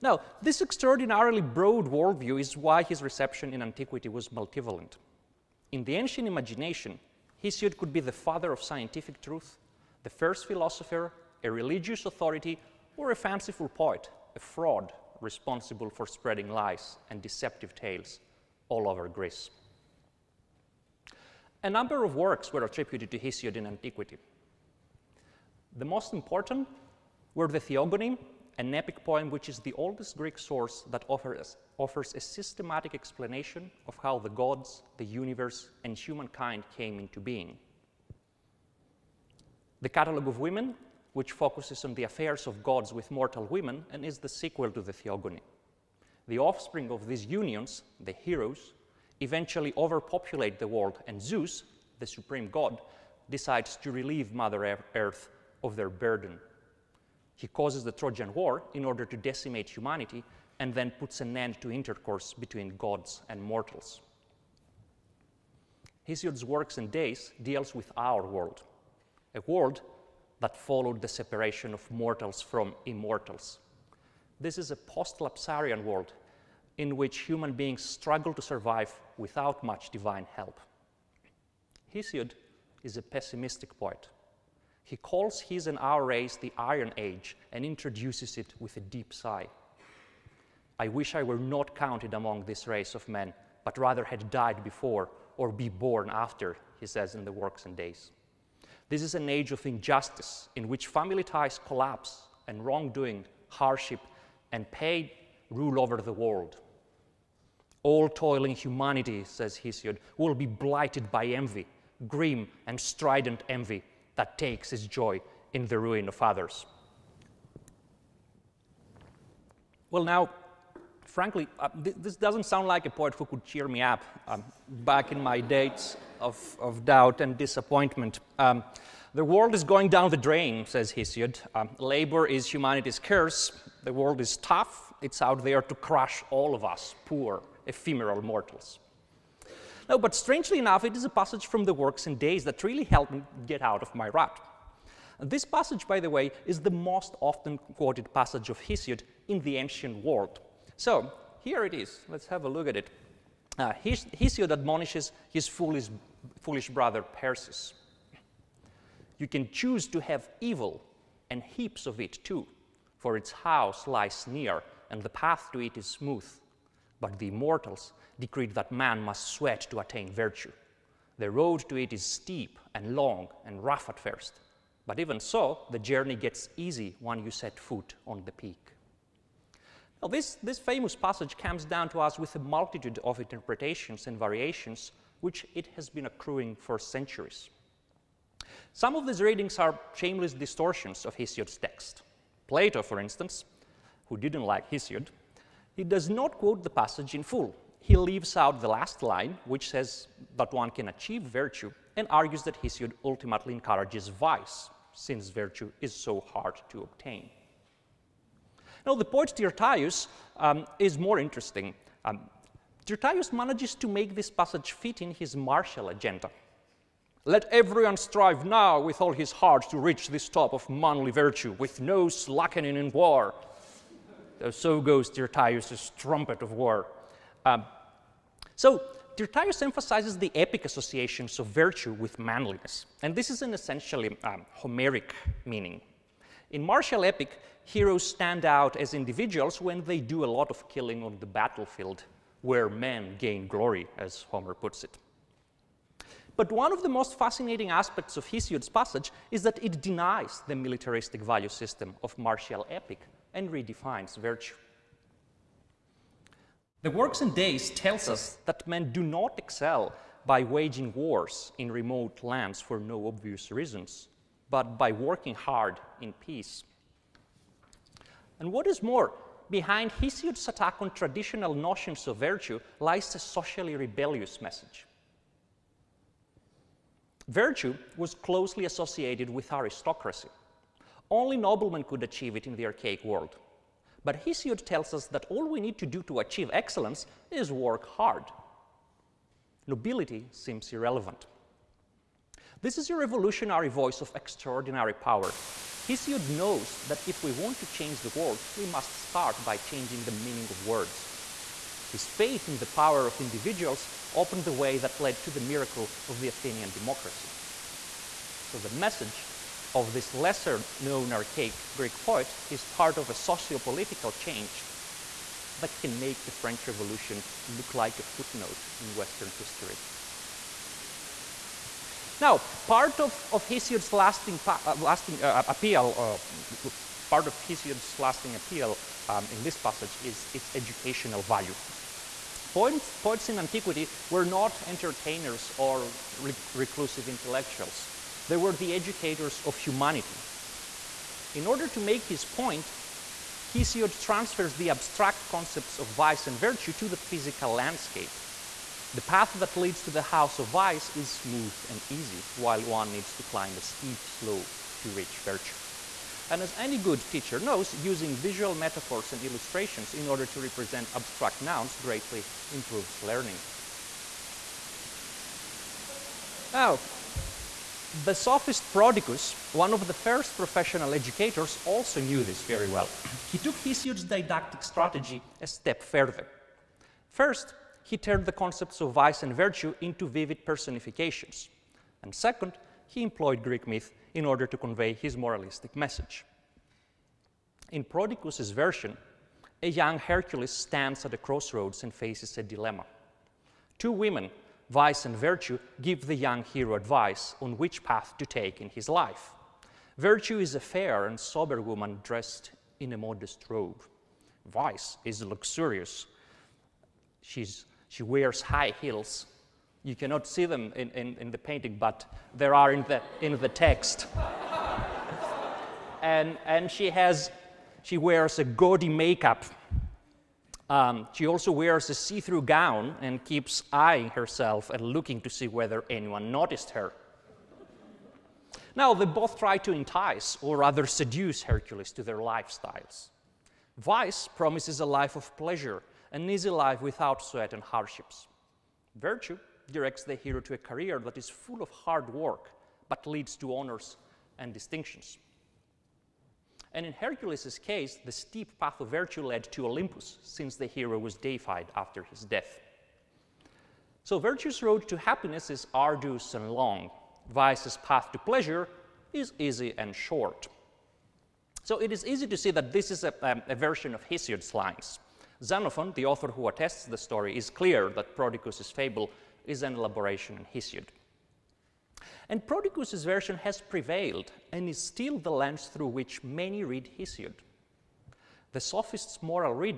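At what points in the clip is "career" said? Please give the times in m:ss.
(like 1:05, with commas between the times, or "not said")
7:20.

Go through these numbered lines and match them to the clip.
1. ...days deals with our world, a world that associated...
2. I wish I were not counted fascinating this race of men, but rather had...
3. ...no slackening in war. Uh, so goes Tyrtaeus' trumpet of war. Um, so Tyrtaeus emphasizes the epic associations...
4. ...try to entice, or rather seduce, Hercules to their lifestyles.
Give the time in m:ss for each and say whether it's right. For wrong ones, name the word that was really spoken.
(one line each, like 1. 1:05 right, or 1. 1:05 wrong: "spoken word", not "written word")
1. 1:06 wrong: "followed", not "associated"
2. 1:30 wrong: "among", not "fascinating"
3. 3:41 right
4. 7:09 right.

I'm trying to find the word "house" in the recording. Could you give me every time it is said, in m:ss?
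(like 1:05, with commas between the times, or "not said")
2:43, 5:50.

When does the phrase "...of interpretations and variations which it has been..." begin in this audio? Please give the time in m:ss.
3:03.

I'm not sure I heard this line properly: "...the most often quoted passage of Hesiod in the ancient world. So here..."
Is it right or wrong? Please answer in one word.
right.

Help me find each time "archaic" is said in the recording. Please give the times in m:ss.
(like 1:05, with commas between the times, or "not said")
4:42, 5:11.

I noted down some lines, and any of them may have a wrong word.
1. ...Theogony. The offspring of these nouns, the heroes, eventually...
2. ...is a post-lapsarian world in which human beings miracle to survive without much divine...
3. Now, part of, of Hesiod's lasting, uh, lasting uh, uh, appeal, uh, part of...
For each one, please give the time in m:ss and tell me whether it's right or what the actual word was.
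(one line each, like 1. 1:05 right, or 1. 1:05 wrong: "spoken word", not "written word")
1. 0:44 wrong: "unions", not "nouns"
2. 1:14 wrong: "struggle", not "miracle"
3. 5:22 right.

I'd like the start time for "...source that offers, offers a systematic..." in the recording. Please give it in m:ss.
0:30.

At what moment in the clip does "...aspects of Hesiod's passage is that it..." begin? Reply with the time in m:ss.
4:07.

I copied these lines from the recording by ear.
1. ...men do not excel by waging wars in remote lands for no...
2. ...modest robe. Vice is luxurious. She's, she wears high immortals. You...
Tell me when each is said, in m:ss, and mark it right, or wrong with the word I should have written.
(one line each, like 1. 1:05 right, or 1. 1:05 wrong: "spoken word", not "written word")
1. 4:18 right
2. 6:42 wrong: "heels", not "immortals".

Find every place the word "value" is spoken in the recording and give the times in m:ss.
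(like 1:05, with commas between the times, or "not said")
4:11, 5:31.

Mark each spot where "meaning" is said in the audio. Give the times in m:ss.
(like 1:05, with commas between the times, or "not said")
3:55, 5:00.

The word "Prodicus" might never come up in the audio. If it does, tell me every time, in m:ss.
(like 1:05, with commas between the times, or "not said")
6:08, 6:27, 7:48, 7:52.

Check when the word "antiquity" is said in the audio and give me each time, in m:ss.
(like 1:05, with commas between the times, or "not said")
0:03, 0:23, 5:33.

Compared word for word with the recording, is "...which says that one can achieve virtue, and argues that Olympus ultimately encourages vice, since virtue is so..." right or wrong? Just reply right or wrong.
wrong.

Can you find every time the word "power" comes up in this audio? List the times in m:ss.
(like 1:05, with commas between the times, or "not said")
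4:54, 5:02.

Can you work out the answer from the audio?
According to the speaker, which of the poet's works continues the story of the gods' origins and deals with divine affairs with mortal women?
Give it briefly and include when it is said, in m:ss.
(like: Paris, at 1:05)
The Catalogue of Women, at 0:39.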